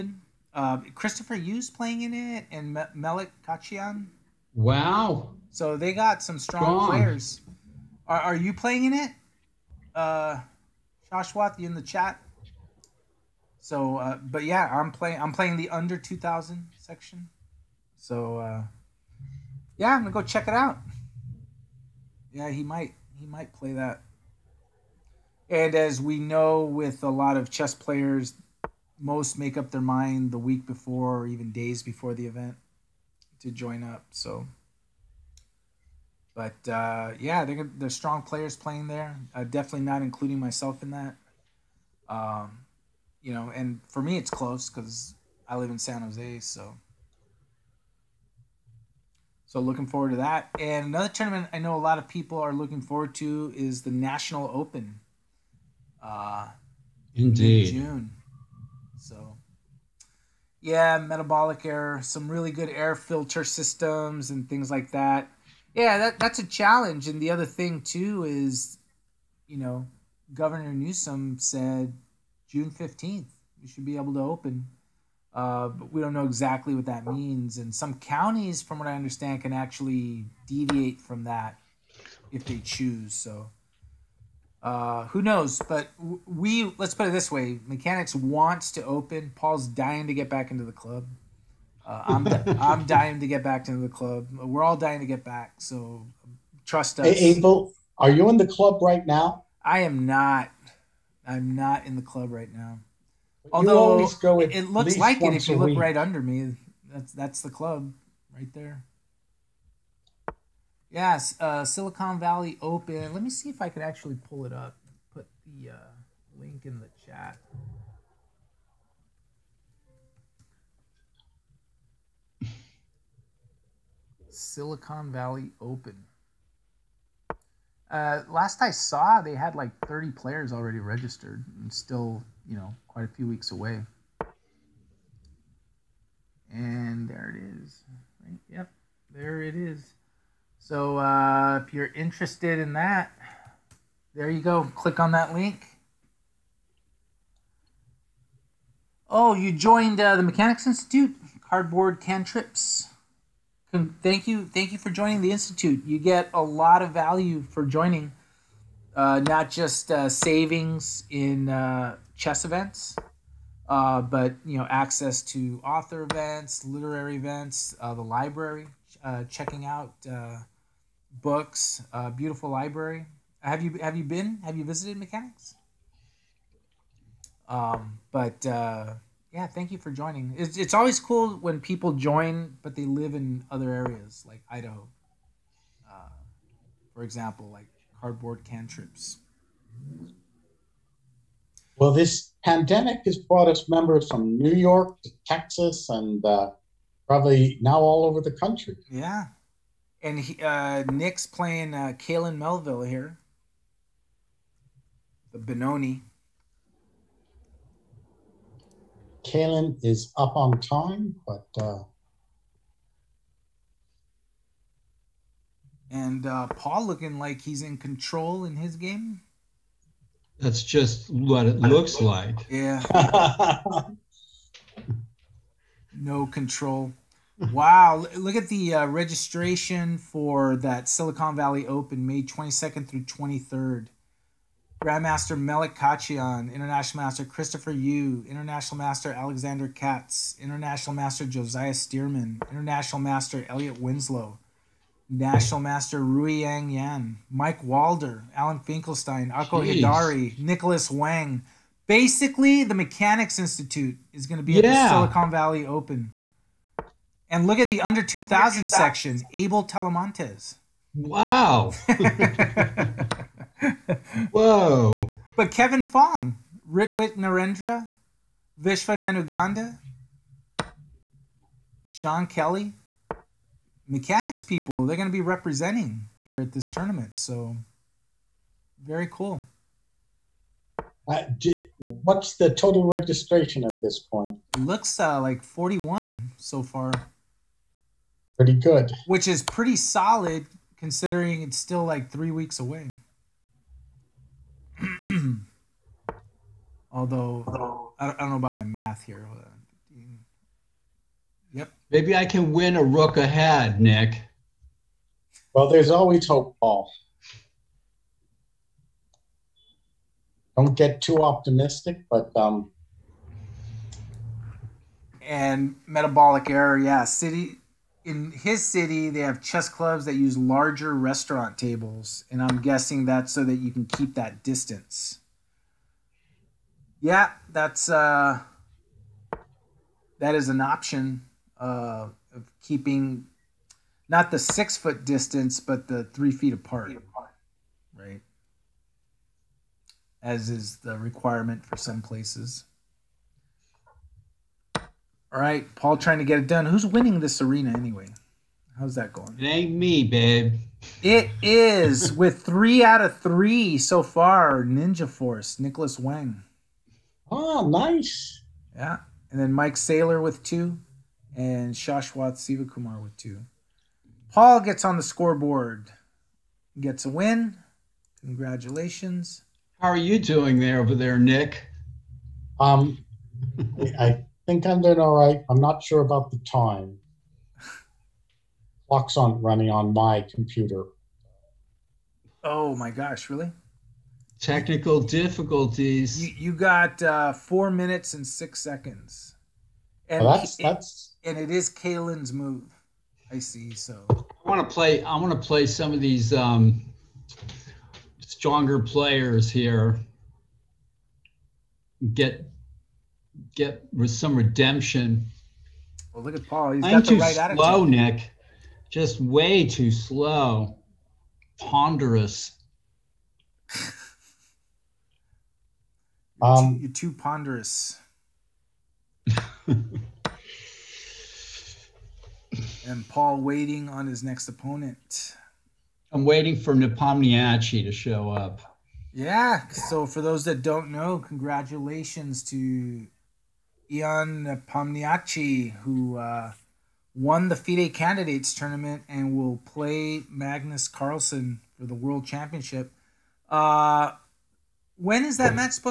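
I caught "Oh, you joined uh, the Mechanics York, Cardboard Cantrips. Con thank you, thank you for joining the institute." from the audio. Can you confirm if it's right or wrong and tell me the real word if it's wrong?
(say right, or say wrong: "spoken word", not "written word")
wrong: "Institute", not "York".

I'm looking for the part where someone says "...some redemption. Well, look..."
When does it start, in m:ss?
6:44.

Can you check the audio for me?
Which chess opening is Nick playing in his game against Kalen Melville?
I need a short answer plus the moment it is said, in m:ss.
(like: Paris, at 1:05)
Benoni, at 3:25.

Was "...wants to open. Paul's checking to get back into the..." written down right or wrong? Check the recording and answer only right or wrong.
wrong.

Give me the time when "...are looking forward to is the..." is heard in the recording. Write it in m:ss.
0:52.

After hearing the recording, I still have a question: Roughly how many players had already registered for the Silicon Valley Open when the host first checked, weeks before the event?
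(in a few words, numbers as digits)
30.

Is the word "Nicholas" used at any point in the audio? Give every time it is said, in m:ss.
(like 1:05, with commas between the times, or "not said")
4:10, 5:55.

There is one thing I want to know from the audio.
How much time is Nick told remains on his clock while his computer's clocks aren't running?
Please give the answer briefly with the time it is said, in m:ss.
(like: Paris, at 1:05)
4 minutes 6 seconds, at 6:27.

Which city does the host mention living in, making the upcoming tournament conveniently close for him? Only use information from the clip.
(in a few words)
San Jose.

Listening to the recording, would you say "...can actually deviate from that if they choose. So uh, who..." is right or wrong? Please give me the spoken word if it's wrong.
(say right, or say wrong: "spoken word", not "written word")
right.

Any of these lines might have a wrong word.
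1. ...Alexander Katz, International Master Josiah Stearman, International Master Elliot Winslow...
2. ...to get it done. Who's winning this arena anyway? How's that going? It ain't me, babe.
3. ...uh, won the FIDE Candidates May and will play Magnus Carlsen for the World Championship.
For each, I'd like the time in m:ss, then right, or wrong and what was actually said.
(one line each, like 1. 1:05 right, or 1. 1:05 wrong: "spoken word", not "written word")
1. 3:59 right
2. 5:46 right
3. 7:16 wrong: "Tournament", not "May".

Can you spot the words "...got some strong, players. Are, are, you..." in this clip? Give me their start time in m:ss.
0:05.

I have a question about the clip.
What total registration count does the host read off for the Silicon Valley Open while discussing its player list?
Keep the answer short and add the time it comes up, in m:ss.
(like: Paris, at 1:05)
41, at 4:45.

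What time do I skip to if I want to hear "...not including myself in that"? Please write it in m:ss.
0:39.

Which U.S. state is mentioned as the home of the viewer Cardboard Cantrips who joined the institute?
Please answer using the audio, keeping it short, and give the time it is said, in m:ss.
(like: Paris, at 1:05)
Idaho, at 3:04.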